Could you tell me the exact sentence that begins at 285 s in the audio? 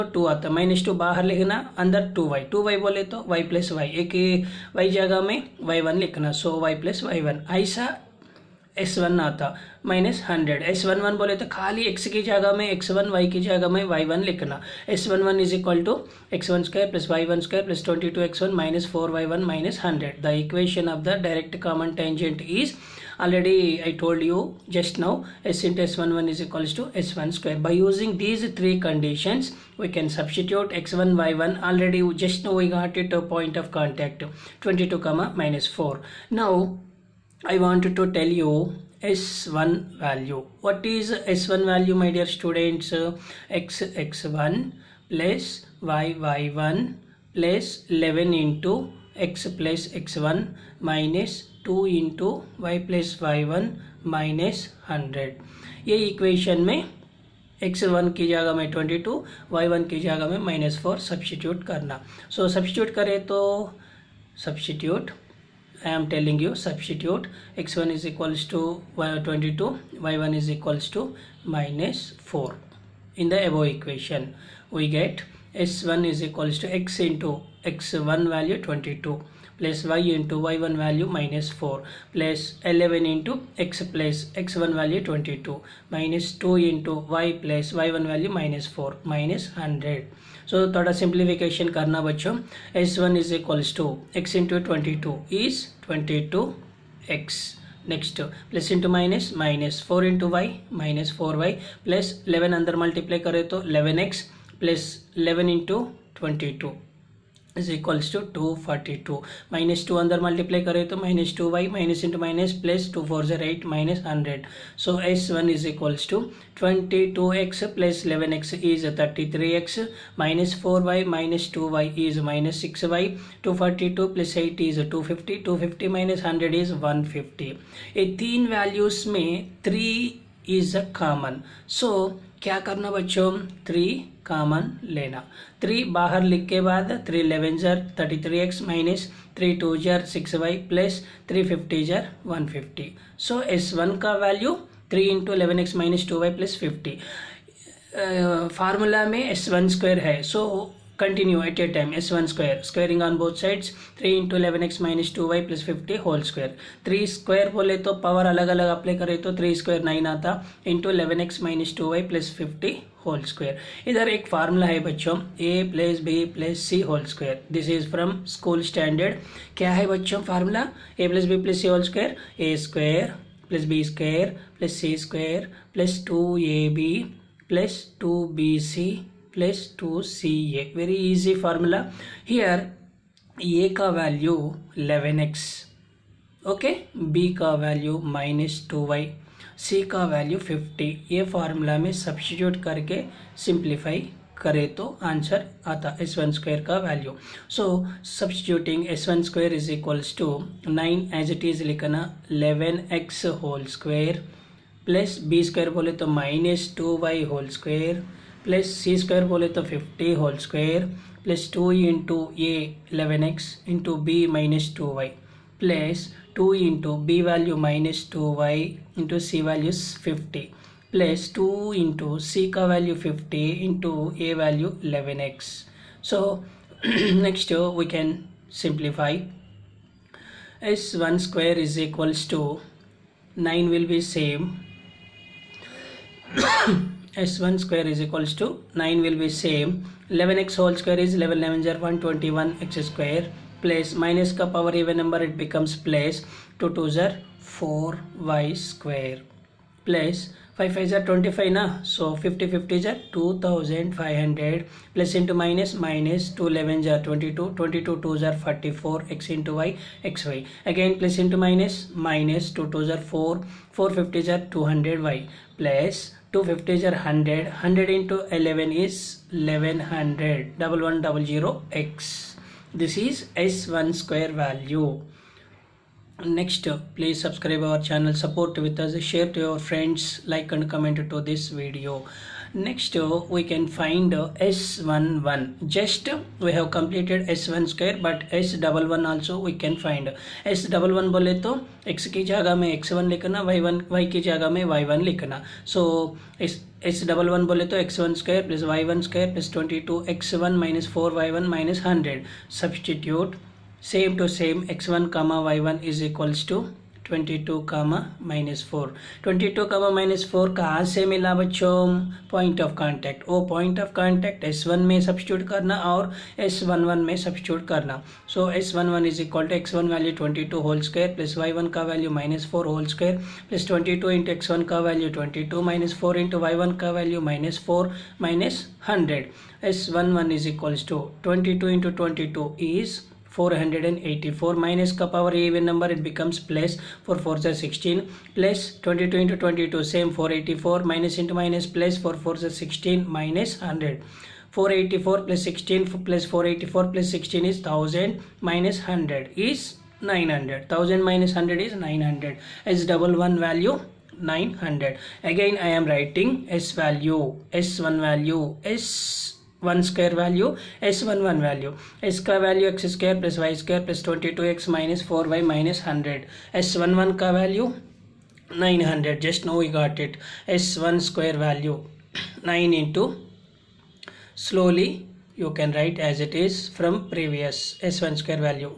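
Just we have completed S1 square, but S11 also we can find.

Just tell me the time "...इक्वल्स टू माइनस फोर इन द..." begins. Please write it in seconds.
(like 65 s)
70 s.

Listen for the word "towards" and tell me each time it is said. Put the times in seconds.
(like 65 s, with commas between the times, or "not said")
not said.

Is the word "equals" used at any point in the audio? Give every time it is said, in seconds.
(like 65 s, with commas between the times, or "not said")
26 s, 231 s, 238 s.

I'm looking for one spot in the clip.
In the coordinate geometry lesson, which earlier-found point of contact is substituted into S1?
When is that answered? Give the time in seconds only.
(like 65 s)
34 s.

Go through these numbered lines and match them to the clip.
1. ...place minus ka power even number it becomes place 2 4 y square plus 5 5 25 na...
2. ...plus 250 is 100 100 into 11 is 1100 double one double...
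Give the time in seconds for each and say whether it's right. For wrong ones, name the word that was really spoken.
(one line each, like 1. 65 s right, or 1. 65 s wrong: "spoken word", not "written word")
1. 243 s right
2. 265 s right.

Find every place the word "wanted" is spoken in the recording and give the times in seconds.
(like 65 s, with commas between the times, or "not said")
37 s.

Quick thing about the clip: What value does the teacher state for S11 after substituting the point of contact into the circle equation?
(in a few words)
900.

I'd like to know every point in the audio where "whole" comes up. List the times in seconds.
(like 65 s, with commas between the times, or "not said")
210 s, 240 s.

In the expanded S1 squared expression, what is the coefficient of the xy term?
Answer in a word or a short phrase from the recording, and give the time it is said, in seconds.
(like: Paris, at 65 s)
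44, at 258 s.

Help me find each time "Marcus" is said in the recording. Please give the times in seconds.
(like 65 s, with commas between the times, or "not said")
not said.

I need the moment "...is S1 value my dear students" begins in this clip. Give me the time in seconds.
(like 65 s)
40 s.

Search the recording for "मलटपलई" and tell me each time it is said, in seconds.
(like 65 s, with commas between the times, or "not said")
102 s, 110 s.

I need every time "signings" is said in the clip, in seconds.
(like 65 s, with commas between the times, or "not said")
not said.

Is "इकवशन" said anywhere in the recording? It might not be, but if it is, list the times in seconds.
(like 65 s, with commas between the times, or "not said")
20 s, 56 s, 73 s.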